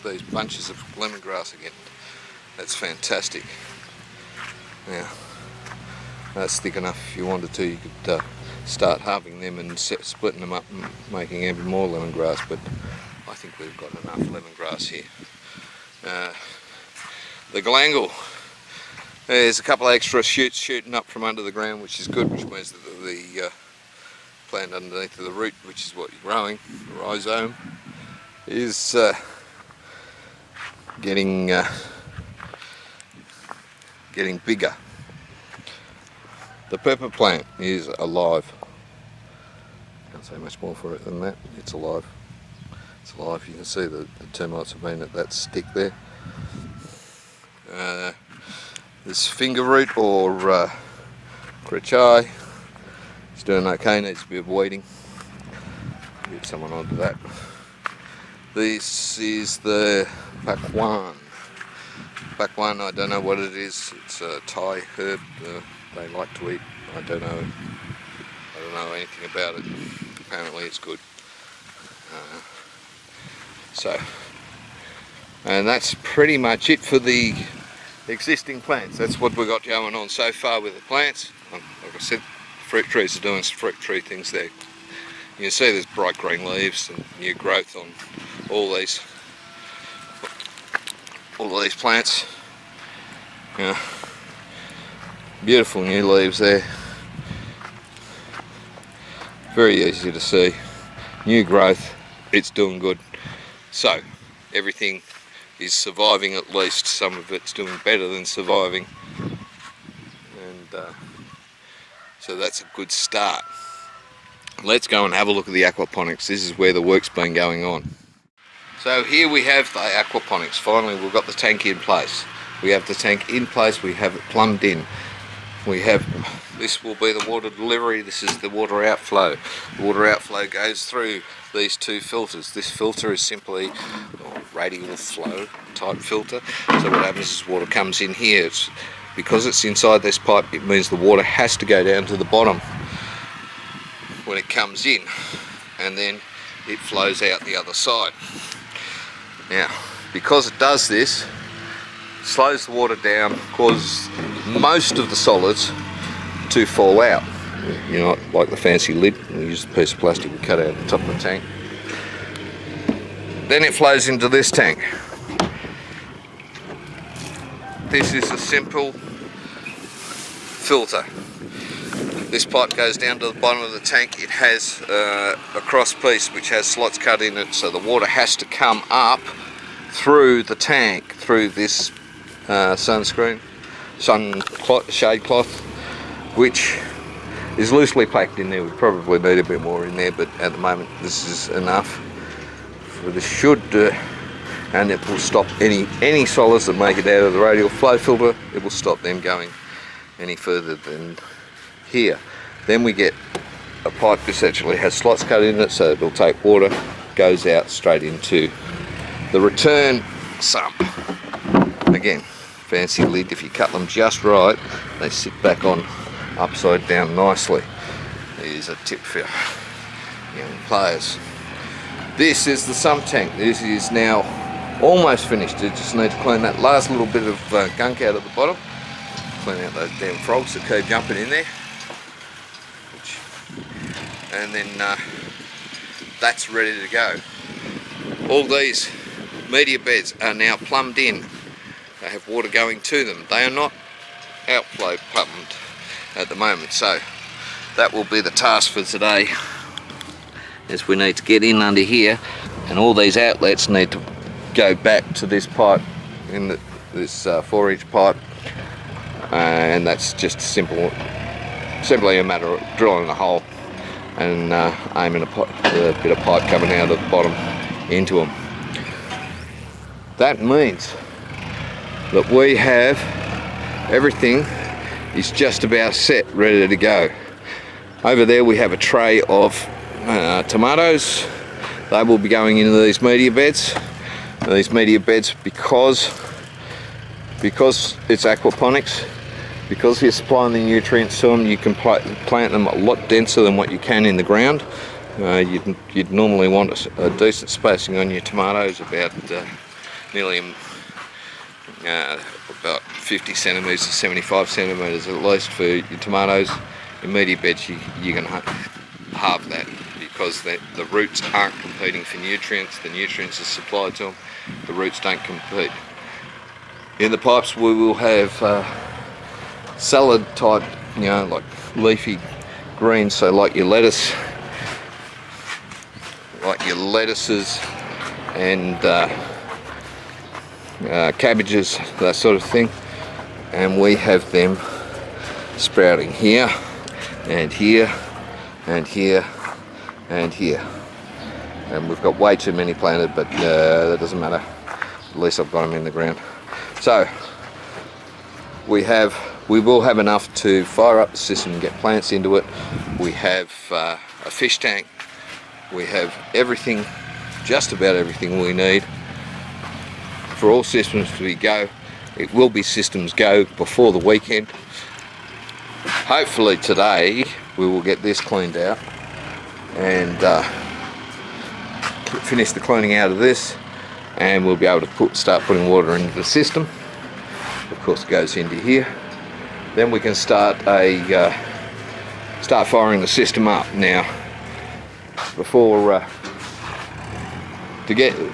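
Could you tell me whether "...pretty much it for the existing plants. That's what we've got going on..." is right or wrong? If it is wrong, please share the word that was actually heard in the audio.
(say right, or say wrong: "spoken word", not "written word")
right.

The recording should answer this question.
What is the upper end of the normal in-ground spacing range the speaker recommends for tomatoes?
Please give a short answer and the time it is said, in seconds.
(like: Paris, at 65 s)
75 centimetres, at 303 s.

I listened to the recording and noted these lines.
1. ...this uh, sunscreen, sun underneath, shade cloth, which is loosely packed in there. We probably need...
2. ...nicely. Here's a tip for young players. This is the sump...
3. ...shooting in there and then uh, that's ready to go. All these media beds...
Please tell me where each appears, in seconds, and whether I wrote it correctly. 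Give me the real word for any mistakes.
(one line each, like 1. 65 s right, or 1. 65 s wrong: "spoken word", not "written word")
1. 181 s wrong: "cloth", not "underneath"
2. 217 s right
3. 230 s wrong: "jumping", not "shooting".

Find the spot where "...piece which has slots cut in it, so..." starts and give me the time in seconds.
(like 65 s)
175 s.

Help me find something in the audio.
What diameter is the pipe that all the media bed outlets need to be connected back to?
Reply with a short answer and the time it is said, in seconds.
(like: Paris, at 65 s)
4 inch, at 257 s.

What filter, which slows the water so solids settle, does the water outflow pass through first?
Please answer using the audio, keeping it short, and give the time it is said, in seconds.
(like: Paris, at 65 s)
radial flow filter, at 134 s.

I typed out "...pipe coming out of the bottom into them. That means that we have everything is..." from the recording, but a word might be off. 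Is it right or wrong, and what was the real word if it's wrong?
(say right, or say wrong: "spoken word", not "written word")
right.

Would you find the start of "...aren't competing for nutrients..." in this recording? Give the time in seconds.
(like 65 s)
311 s.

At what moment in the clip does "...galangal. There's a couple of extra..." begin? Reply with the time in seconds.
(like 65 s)
17 s.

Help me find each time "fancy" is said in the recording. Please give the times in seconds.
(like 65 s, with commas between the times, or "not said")
158 s, 212 s.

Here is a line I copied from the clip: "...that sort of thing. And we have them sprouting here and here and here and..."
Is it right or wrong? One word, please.
right.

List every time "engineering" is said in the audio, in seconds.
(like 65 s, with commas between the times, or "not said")
not said.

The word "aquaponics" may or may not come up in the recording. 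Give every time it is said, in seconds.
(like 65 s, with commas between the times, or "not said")
115 s, 119 s, 288 s.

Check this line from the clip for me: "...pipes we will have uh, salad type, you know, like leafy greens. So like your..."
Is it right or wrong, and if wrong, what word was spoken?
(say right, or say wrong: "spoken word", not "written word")
right.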